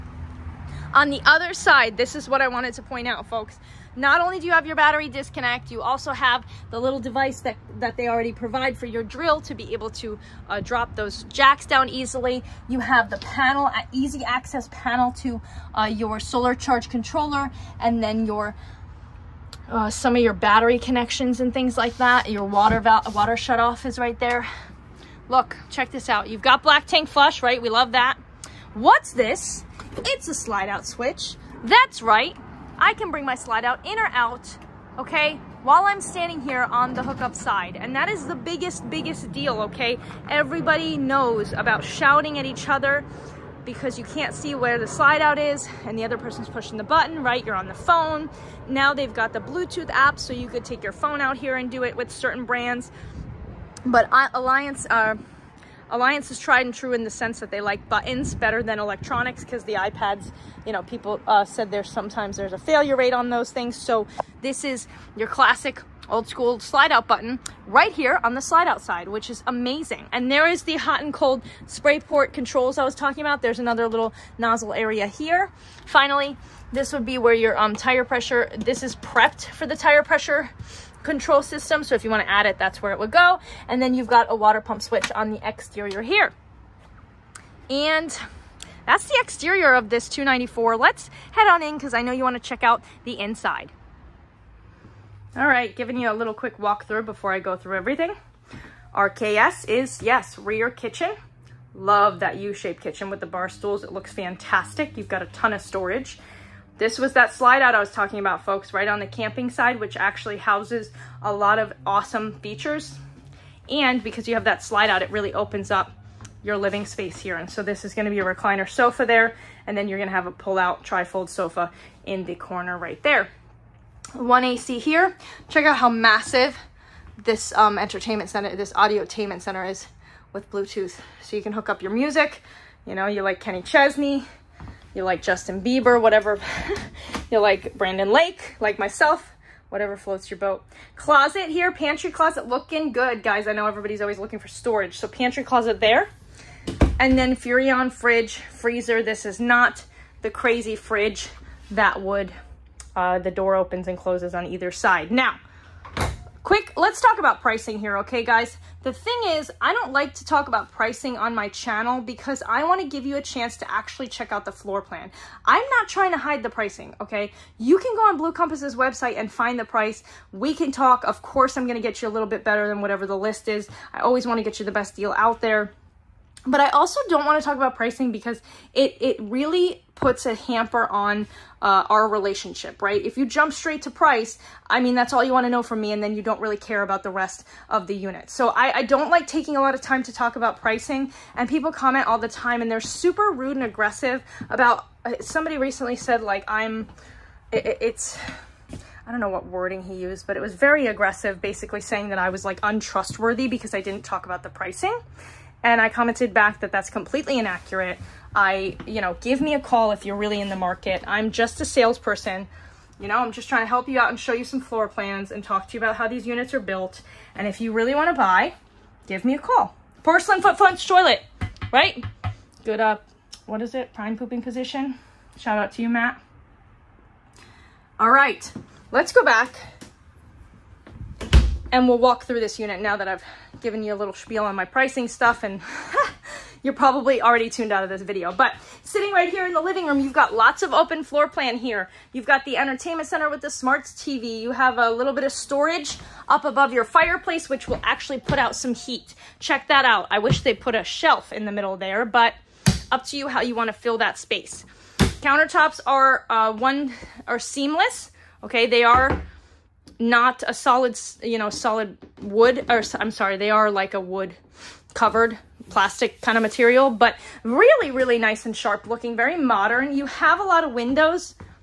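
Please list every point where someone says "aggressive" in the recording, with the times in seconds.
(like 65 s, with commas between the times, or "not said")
193 s, 200 s.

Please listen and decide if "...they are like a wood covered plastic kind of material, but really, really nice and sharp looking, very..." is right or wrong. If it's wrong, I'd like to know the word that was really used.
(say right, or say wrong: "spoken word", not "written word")
right.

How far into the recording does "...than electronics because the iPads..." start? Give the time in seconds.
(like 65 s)
58 s.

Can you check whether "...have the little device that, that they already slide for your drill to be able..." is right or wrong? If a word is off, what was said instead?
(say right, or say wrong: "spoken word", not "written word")
wrong: "provide", not "slide".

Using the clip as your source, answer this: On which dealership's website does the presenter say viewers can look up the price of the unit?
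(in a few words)
Blue Compass.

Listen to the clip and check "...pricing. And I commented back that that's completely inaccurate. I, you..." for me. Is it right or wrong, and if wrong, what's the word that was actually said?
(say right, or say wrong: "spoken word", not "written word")
right.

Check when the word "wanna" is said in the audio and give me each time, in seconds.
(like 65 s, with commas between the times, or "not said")
82 s, 92 s.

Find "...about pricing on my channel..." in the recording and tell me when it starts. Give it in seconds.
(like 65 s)
160 s.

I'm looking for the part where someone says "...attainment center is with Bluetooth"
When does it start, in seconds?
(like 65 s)
129 s.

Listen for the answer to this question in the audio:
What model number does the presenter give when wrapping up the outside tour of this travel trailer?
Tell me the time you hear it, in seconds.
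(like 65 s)
90 s.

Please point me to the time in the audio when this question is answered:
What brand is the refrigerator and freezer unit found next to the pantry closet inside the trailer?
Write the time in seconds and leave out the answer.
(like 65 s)
147 s.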